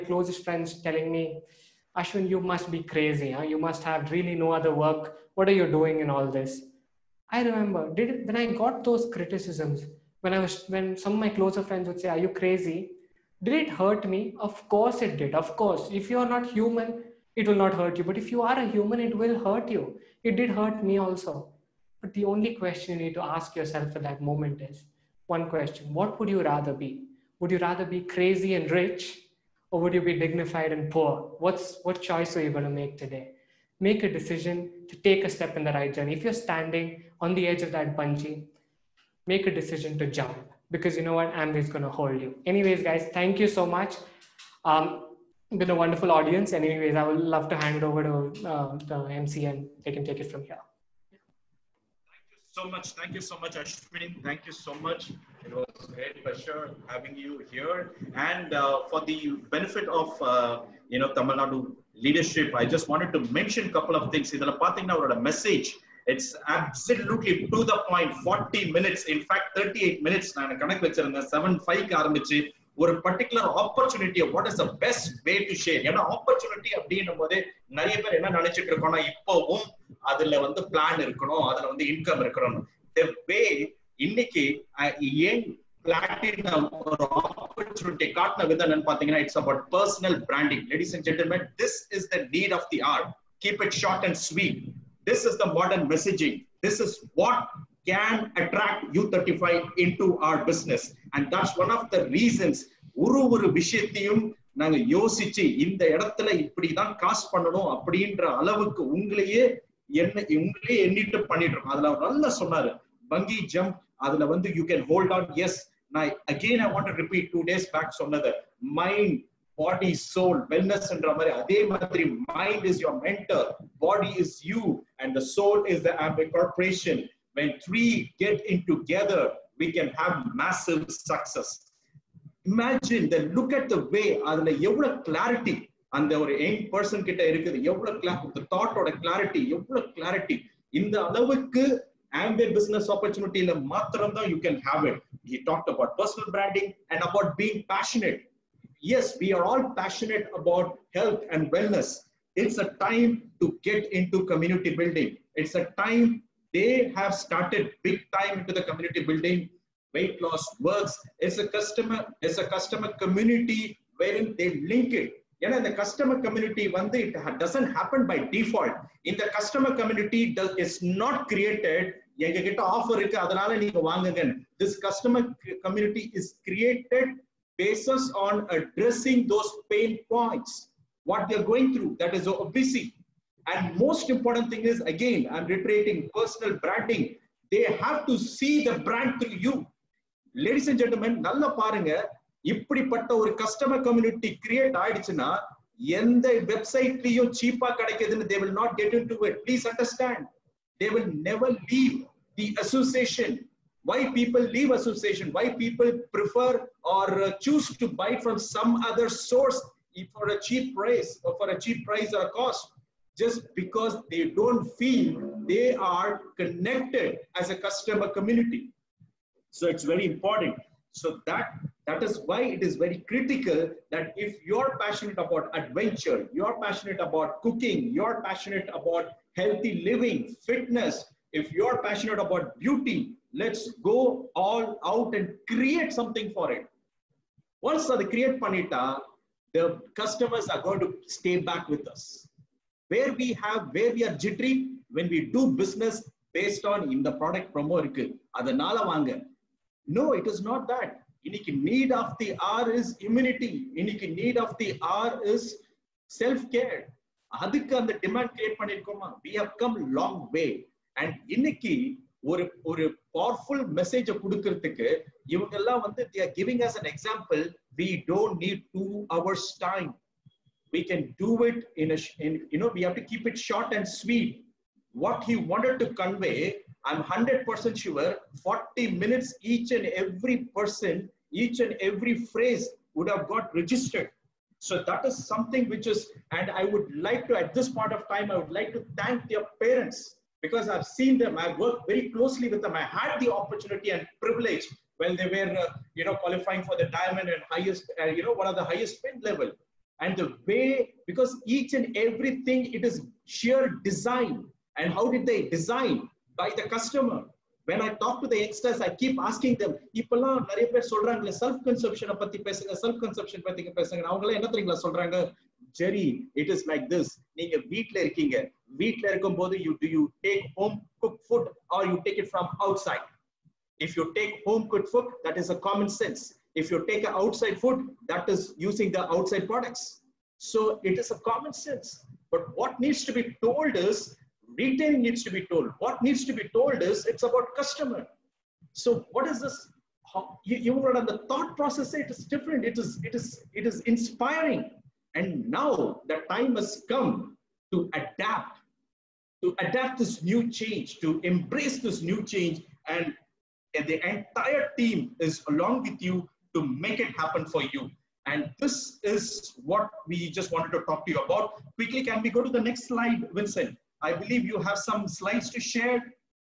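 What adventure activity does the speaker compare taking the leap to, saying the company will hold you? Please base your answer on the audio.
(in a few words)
bungee.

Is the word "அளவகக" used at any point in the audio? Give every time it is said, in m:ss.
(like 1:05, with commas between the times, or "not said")
1:48, 2:21.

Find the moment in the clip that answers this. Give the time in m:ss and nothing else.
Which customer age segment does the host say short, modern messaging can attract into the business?
1:38.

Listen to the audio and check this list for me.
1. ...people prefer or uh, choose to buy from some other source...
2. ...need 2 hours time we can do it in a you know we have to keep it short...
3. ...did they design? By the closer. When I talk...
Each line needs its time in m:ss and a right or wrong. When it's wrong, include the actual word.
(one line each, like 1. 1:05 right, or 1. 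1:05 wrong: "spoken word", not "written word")
1. 3:25 right
2. 4:28 right
3. 5:05 wrong: "customer", not "closer".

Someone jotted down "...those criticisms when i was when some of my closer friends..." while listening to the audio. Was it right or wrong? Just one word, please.
right.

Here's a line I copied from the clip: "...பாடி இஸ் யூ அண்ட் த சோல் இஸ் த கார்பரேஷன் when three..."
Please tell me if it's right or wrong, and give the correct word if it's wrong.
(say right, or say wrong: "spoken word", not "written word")
right.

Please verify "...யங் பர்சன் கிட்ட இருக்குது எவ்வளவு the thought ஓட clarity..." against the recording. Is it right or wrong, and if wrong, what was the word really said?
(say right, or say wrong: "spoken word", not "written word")
right.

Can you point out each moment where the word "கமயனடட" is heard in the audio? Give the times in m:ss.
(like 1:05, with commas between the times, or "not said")
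2:55, 3:13.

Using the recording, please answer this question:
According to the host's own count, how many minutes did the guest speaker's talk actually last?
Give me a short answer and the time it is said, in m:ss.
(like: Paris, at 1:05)
38 minutes, at 1:09.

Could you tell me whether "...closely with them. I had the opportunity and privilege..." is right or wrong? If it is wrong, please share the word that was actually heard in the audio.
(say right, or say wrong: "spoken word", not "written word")
right.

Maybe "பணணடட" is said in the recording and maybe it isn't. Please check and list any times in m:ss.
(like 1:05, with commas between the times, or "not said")
1:51, 3:58.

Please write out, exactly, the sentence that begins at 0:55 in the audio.
It was a great pleasure having you here.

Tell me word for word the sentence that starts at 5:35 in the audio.
What needs to be told is it's about customer.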